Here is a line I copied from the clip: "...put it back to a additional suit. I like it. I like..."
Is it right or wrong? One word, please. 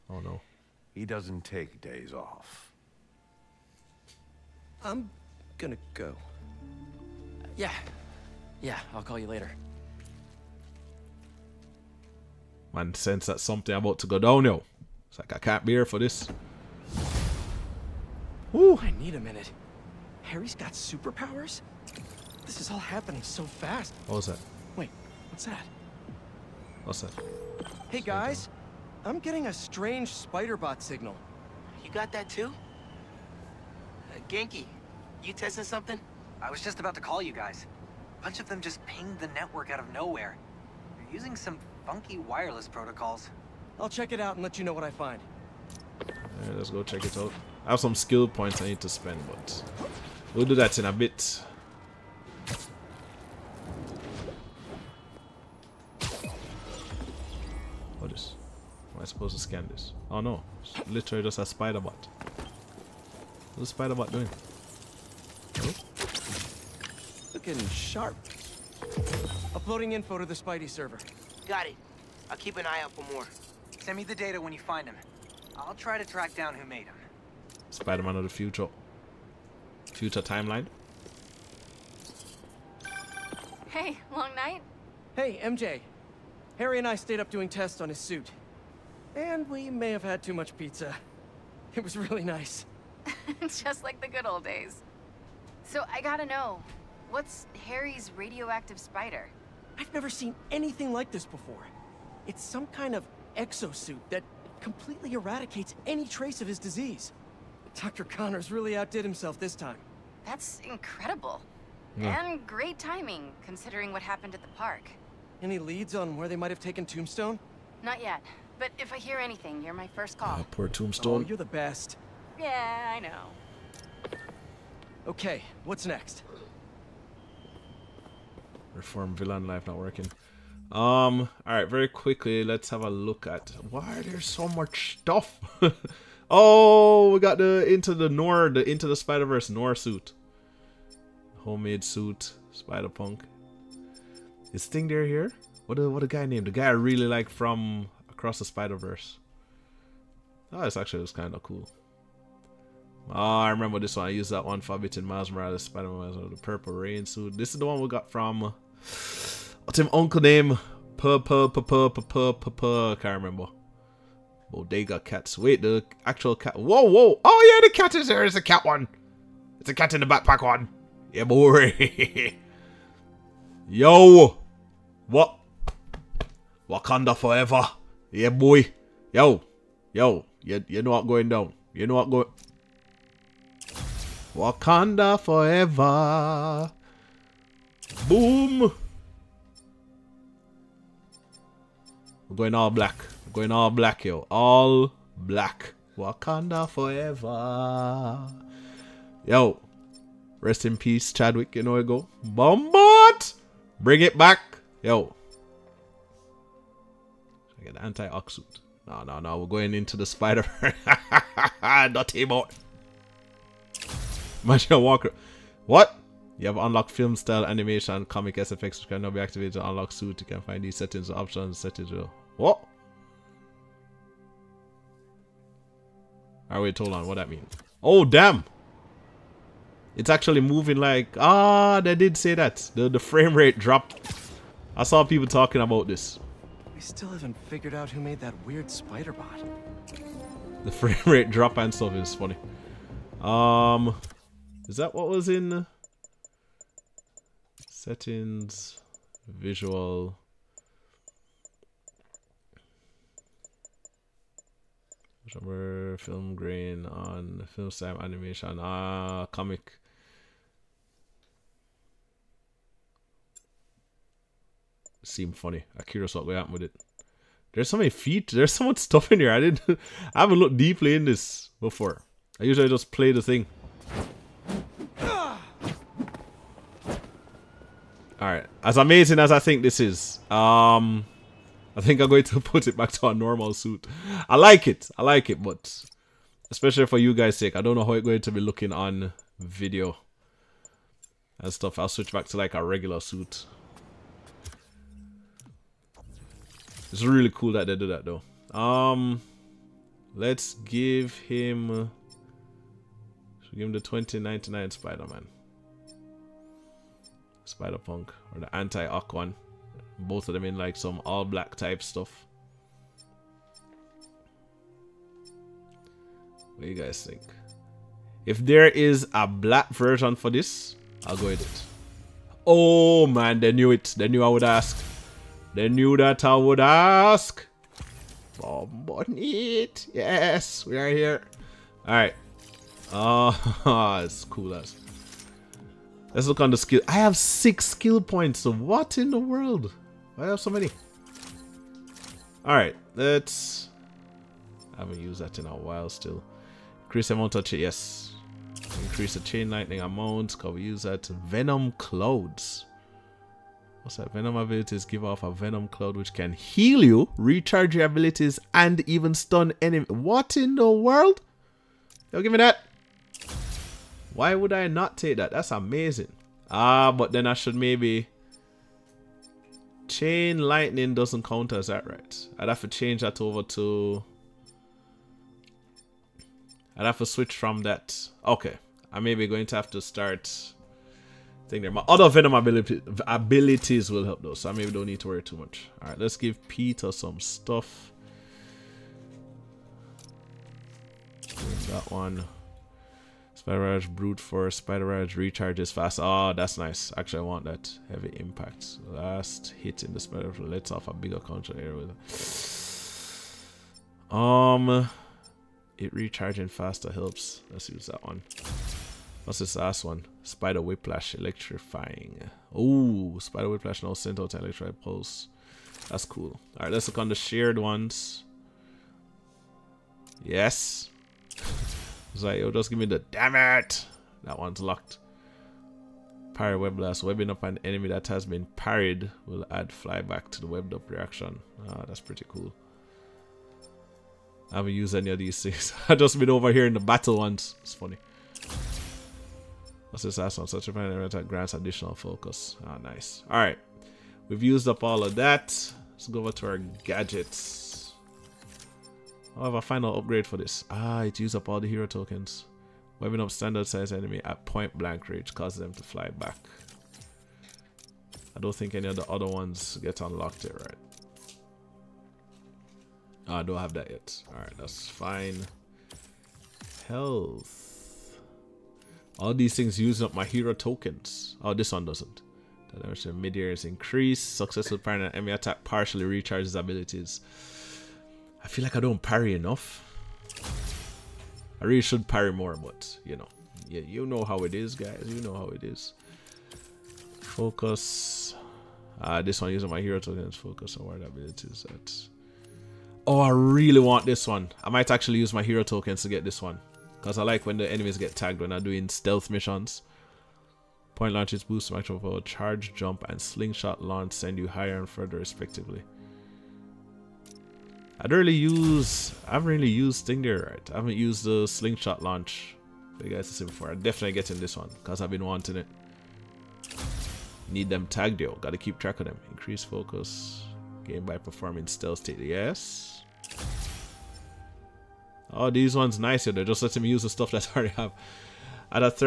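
wrong.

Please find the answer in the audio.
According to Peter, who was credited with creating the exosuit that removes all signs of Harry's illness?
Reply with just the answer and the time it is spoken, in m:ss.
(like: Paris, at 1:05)
Dr. Connors, at 1:47.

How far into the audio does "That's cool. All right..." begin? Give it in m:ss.
6:55.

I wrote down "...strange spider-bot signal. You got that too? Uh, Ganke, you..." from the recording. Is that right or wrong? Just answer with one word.
right.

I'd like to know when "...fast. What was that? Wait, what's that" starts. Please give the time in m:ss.
0:23.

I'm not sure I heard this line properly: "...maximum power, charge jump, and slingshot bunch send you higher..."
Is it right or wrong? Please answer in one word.
wrong.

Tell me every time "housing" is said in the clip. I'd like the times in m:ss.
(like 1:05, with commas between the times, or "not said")
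not said.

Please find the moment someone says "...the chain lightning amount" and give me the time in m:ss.
5:49.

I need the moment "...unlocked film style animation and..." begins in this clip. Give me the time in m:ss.
3:36.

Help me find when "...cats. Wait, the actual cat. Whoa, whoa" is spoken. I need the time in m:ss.
2:45.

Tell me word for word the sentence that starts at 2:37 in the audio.
This is the one we got from What's his uncle name?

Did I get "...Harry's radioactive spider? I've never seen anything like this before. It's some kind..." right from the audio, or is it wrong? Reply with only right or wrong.
right.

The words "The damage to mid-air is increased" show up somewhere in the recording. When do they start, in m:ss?
7:52.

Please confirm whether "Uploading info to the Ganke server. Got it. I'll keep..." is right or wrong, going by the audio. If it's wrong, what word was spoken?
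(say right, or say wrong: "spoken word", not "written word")
wrong: "Spidey", not "Ganke".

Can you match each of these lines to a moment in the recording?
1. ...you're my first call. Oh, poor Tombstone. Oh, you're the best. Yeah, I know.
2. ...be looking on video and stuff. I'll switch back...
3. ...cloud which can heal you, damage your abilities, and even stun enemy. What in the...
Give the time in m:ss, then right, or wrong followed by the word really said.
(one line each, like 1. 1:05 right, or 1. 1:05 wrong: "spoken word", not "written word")
1. 1:59 right
2. 4:48 right
3. 5:55 wrong: "recharge", not "damage".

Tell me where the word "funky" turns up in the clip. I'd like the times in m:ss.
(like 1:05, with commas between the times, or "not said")
0:41.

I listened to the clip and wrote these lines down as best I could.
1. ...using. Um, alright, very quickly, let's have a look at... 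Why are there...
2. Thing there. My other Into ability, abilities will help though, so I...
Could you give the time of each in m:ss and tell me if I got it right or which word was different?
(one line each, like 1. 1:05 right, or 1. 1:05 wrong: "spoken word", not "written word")
1. 2:09 wrong: "working", not "using"
2. 6:21 wrong: "Venom", not "Into".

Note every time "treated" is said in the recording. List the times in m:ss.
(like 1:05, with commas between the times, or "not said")
not said.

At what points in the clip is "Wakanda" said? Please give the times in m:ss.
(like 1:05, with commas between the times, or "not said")
2:56, 3:04, 3:15.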